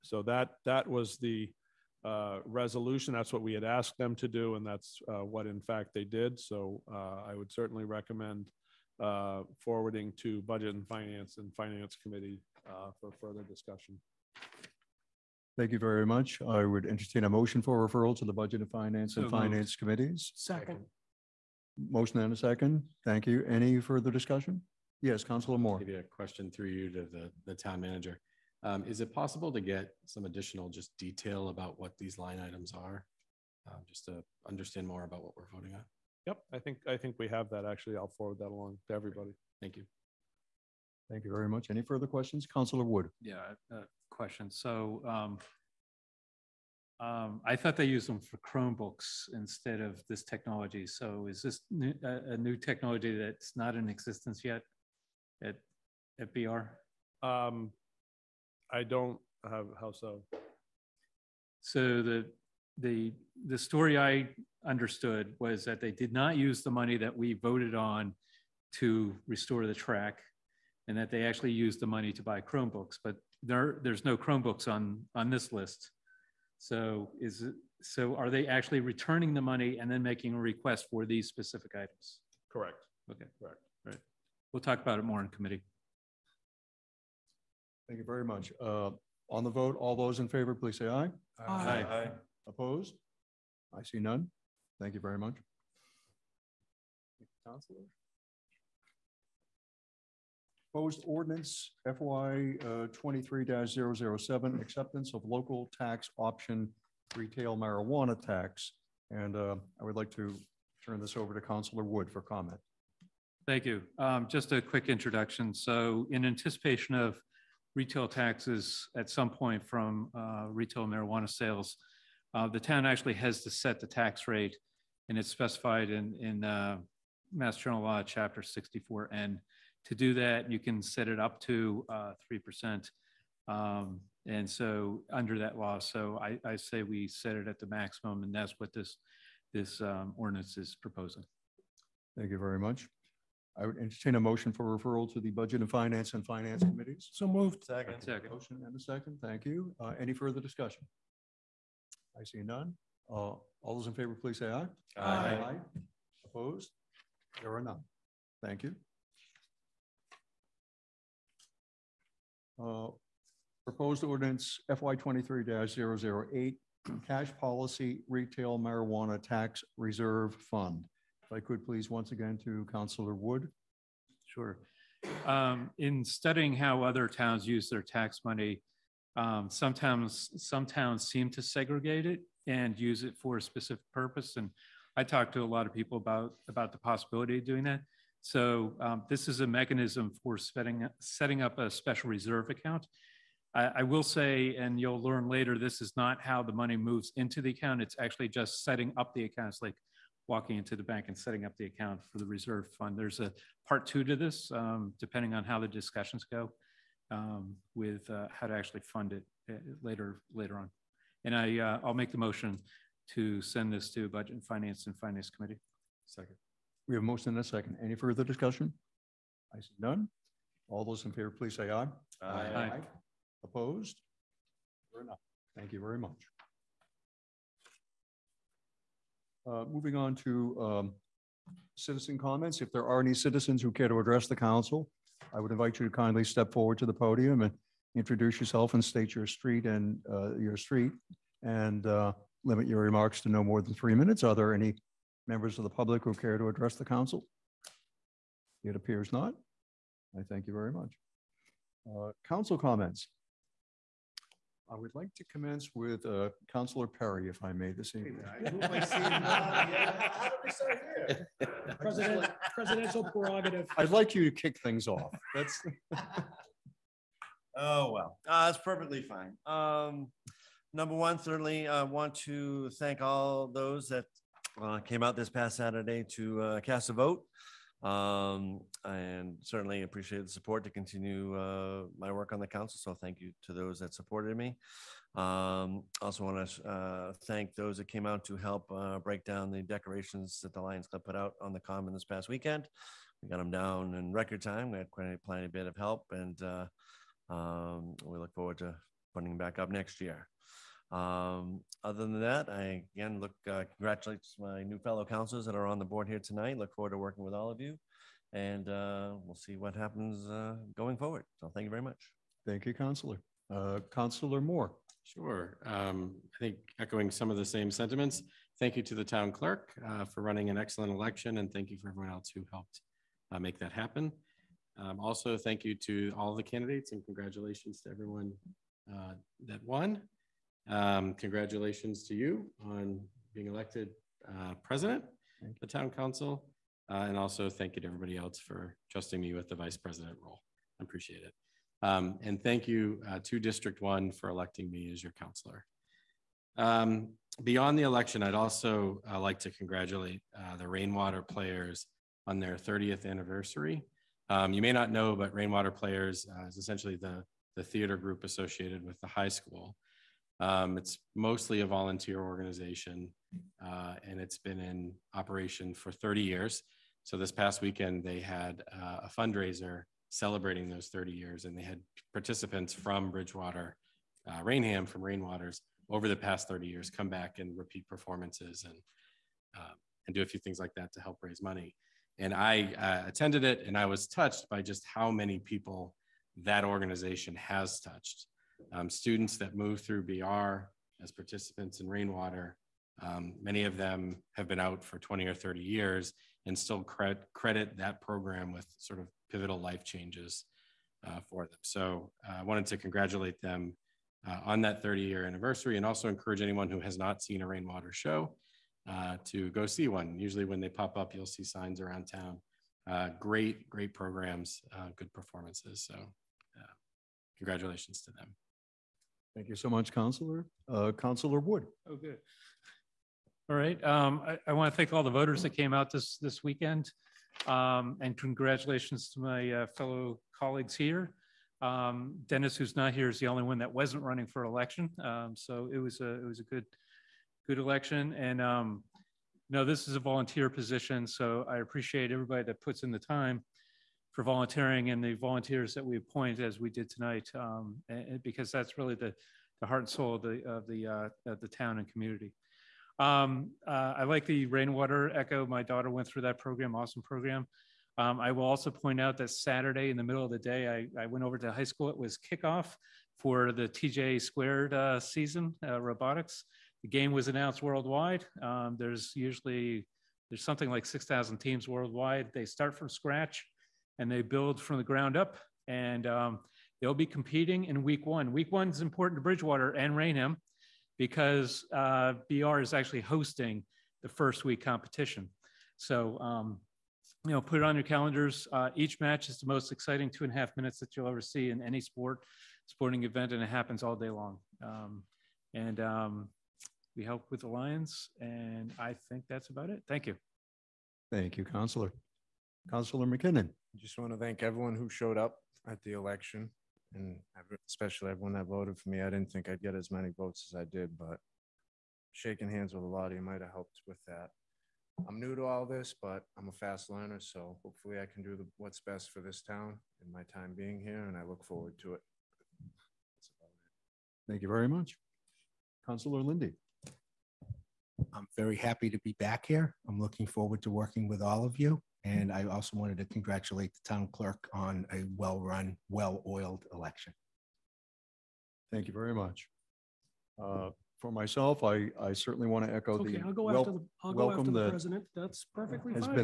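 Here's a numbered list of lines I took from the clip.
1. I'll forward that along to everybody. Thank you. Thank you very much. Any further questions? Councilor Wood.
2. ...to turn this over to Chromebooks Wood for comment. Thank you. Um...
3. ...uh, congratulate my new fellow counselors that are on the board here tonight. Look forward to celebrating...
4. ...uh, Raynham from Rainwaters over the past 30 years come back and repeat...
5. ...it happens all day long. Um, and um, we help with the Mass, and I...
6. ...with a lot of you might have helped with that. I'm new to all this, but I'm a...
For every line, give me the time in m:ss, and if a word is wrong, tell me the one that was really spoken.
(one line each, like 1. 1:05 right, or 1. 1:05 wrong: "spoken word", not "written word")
1. 0:37 right
2. 1:50 wrong: "Councillor", not "Chromebooks"
3. 5:03 wrong: "working", not "celebrating"
4. 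6:14 right
5. 8:13 wrong: "Lions", not "Mass"
6. 8:32 right.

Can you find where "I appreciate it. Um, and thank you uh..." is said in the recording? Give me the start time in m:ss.
5:40.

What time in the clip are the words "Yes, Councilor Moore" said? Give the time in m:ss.
0:25.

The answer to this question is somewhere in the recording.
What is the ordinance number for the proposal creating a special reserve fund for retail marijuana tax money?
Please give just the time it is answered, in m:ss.
2:44.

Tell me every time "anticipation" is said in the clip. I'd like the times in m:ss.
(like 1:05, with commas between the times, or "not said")
1:56.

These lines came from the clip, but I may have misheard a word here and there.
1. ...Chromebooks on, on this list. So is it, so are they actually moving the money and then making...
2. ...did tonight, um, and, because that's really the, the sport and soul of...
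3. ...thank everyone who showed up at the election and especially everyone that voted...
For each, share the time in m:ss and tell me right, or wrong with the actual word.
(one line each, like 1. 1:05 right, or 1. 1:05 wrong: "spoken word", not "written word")
1. 1:14 wrong: "returning", not "moving"
2. 7:26 wrong: "heart", not "sport"
3. 8:24 right.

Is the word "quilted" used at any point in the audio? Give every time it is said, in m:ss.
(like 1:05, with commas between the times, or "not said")
not said.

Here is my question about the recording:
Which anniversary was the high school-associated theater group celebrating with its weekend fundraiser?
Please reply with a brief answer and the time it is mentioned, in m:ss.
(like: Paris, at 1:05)
30th, at 5:52.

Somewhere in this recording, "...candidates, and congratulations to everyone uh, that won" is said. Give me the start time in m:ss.
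5:26.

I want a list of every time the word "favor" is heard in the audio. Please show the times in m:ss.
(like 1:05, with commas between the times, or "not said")
1:30, 2:33, 3:41.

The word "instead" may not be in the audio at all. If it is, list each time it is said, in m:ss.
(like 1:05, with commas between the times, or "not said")
0:49.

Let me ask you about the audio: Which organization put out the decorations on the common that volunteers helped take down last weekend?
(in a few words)
Lions Club.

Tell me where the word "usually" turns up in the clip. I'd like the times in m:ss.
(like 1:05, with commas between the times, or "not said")
6:50, 7:49.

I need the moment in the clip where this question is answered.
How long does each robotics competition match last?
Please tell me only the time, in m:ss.
8:10.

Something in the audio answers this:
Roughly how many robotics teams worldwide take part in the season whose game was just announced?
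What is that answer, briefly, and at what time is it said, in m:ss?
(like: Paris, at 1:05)
6,000, at 7:50.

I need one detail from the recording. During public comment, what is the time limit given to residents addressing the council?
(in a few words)
three minutes.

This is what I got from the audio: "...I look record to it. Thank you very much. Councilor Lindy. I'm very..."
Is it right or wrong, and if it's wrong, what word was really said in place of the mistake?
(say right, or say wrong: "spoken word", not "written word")
wrong: "forward", not "record".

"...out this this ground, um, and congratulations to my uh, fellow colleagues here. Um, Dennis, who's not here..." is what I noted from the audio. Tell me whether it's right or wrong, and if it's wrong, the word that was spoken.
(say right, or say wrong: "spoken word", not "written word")
wrong: "weekend", not "ground".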